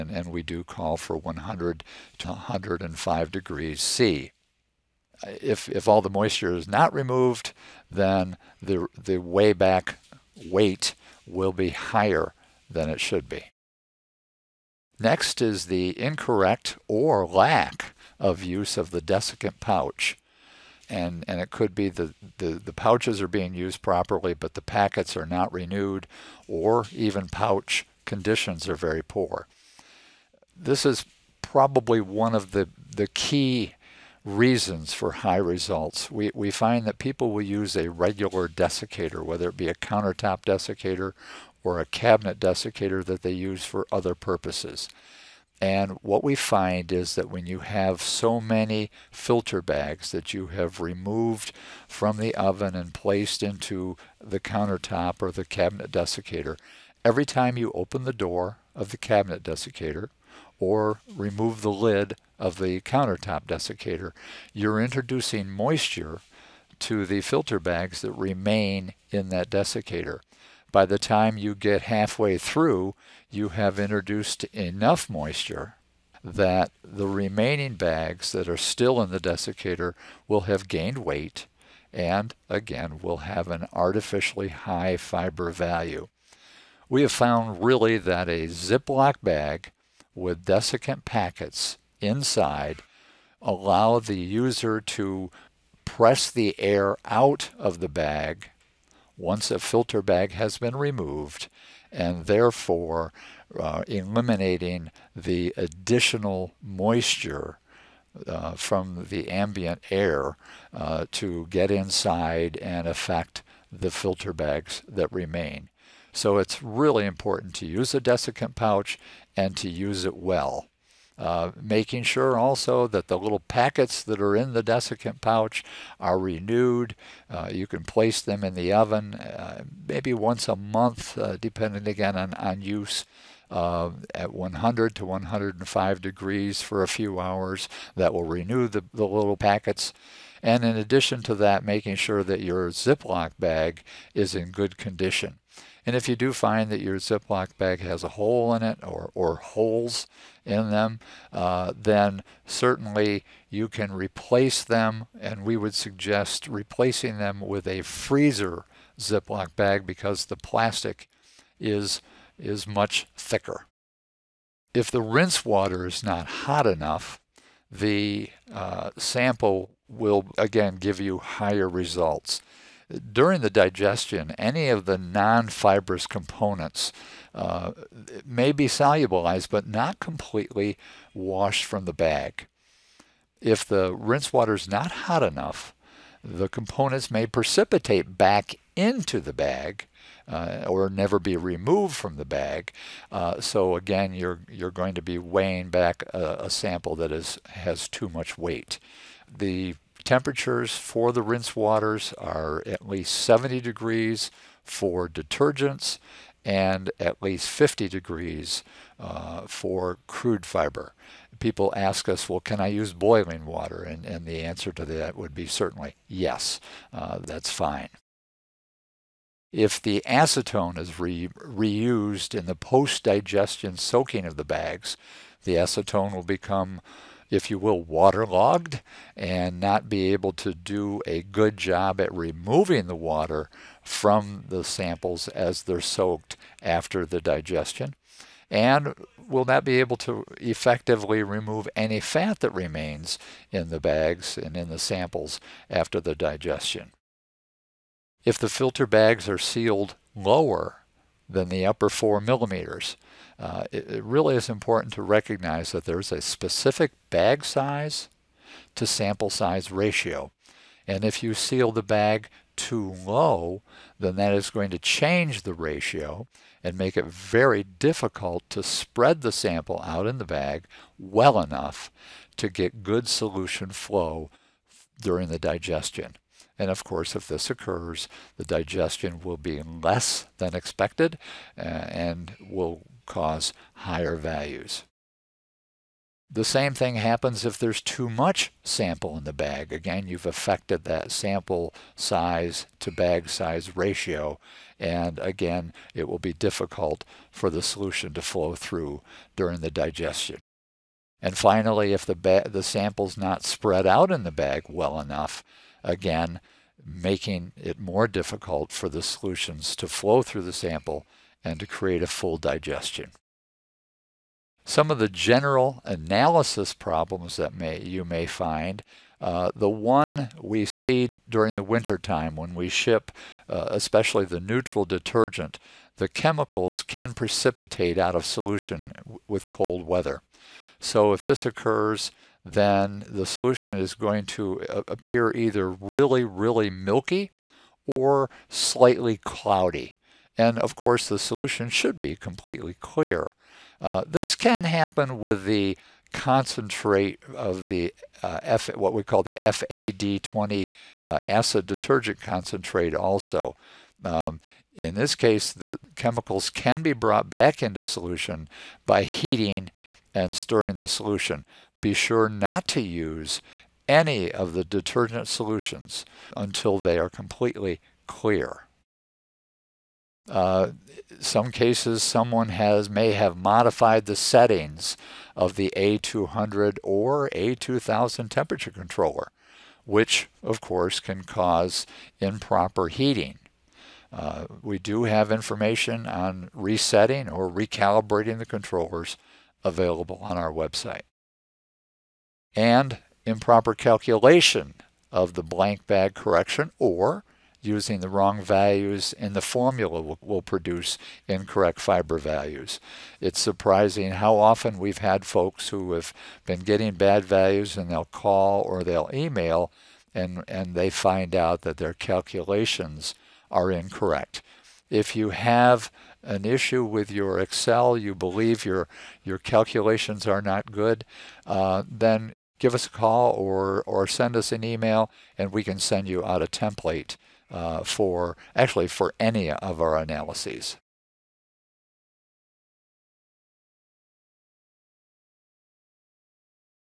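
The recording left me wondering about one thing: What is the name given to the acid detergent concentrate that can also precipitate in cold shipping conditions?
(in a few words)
FAD20.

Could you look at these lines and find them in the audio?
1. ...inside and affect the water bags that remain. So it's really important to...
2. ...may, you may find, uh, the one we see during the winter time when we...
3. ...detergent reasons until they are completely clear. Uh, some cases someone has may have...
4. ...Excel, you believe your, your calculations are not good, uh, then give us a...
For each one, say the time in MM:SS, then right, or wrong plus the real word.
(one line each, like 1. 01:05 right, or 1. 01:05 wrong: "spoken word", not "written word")
1. 01:51 wrong: "filter", not "water"
2. 05:17 right
3. 06:04 wrong: "solutions", not "reasons"
4. 06:57 right.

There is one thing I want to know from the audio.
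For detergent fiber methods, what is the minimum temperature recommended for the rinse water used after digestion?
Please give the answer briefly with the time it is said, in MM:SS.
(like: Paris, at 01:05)
70 degrees, at 03:22.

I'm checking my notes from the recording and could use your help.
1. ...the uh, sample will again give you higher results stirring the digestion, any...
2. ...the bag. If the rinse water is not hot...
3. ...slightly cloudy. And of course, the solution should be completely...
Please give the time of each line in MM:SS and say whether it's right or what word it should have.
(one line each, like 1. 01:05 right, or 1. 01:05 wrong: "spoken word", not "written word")
1. 02:47 wrong: "during", not "stirring"
2. 03:01 right
3. 05:38 right.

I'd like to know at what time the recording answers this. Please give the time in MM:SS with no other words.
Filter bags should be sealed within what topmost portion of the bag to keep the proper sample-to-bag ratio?
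04:11.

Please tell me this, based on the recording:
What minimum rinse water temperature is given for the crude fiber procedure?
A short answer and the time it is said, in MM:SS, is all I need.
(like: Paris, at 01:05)
50 degrees, at 03:26.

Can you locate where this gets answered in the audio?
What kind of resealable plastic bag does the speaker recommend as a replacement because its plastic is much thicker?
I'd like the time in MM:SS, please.
02:37.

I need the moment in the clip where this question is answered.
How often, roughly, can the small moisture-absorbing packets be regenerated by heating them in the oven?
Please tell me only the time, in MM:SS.
02:10.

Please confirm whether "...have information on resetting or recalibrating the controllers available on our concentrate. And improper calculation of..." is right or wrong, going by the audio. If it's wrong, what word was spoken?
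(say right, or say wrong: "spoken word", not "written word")
wrong: "website", not "concentrate".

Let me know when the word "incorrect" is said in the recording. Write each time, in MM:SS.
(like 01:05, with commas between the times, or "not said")
00:16, 06:41, 06:53.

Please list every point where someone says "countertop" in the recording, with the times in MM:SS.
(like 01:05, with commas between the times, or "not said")
00:39, 00:54, 01:02.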